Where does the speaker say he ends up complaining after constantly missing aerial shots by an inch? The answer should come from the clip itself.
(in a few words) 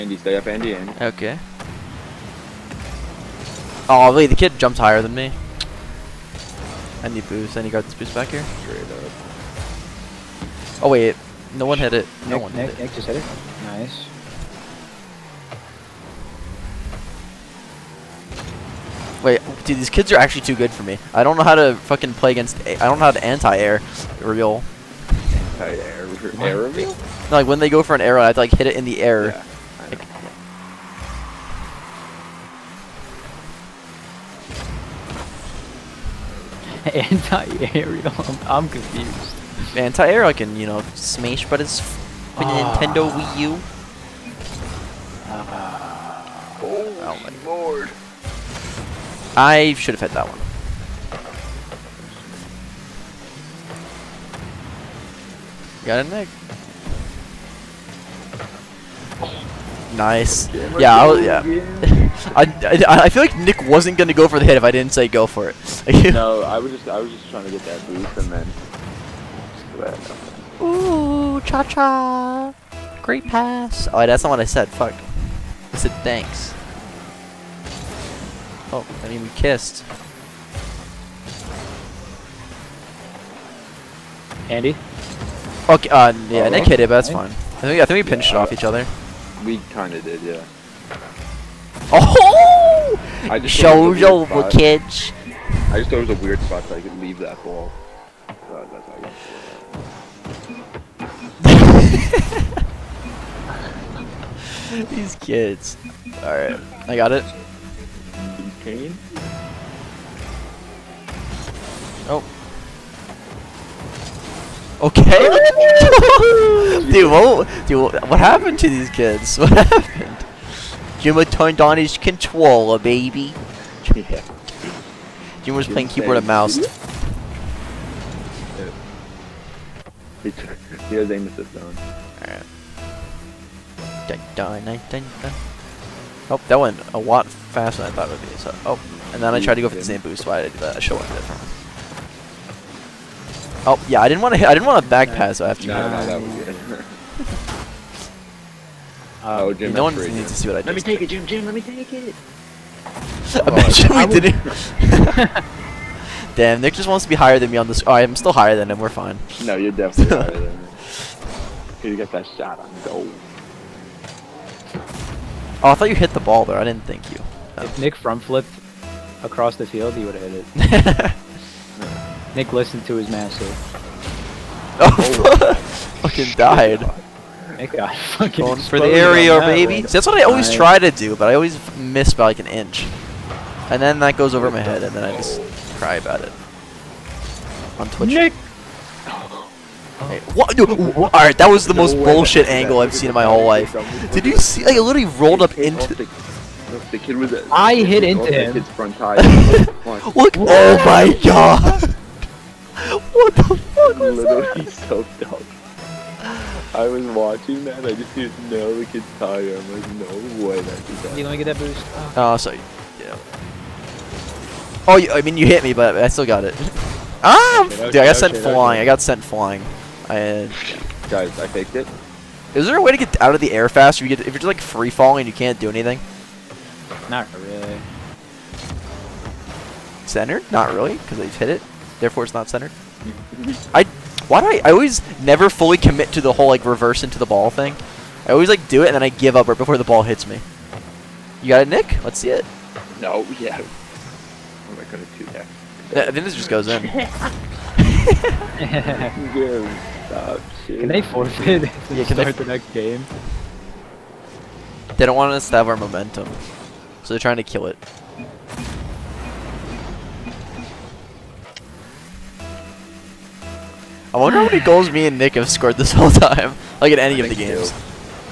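Twitch.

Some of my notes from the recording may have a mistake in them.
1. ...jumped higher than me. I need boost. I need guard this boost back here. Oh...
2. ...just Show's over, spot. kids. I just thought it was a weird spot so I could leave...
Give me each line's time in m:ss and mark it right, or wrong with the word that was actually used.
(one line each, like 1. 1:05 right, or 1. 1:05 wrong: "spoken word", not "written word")
1. 0:04 right
2. 1:33 right.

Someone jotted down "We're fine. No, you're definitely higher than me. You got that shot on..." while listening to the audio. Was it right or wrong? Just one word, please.
right.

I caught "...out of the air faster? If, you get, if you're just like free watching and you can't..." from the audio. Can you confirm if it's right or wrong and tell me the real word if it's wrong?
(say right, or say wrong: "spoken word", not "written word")
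wrong: "falling", not "watching".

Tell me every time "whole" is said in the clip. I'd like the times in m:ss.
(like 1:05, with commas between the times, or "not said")
3:13, 3:56, 4:25.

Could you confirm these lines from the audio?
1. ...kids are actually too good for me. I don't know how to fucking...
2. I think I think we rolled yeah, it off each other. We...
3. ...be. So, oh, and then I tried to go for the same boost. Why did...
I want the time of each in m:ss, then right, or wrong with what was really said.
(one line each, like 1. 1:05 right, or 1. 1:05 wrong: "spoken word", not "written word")
1. 0:19 right
2. 1:27 wrong: "pinched", not "rolled"
3. 2:18 right.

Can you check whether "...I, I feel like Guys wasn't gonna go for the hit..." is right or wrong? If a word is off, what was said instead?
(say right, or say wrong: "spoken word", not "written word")
wrong: "Nick", not "Guys".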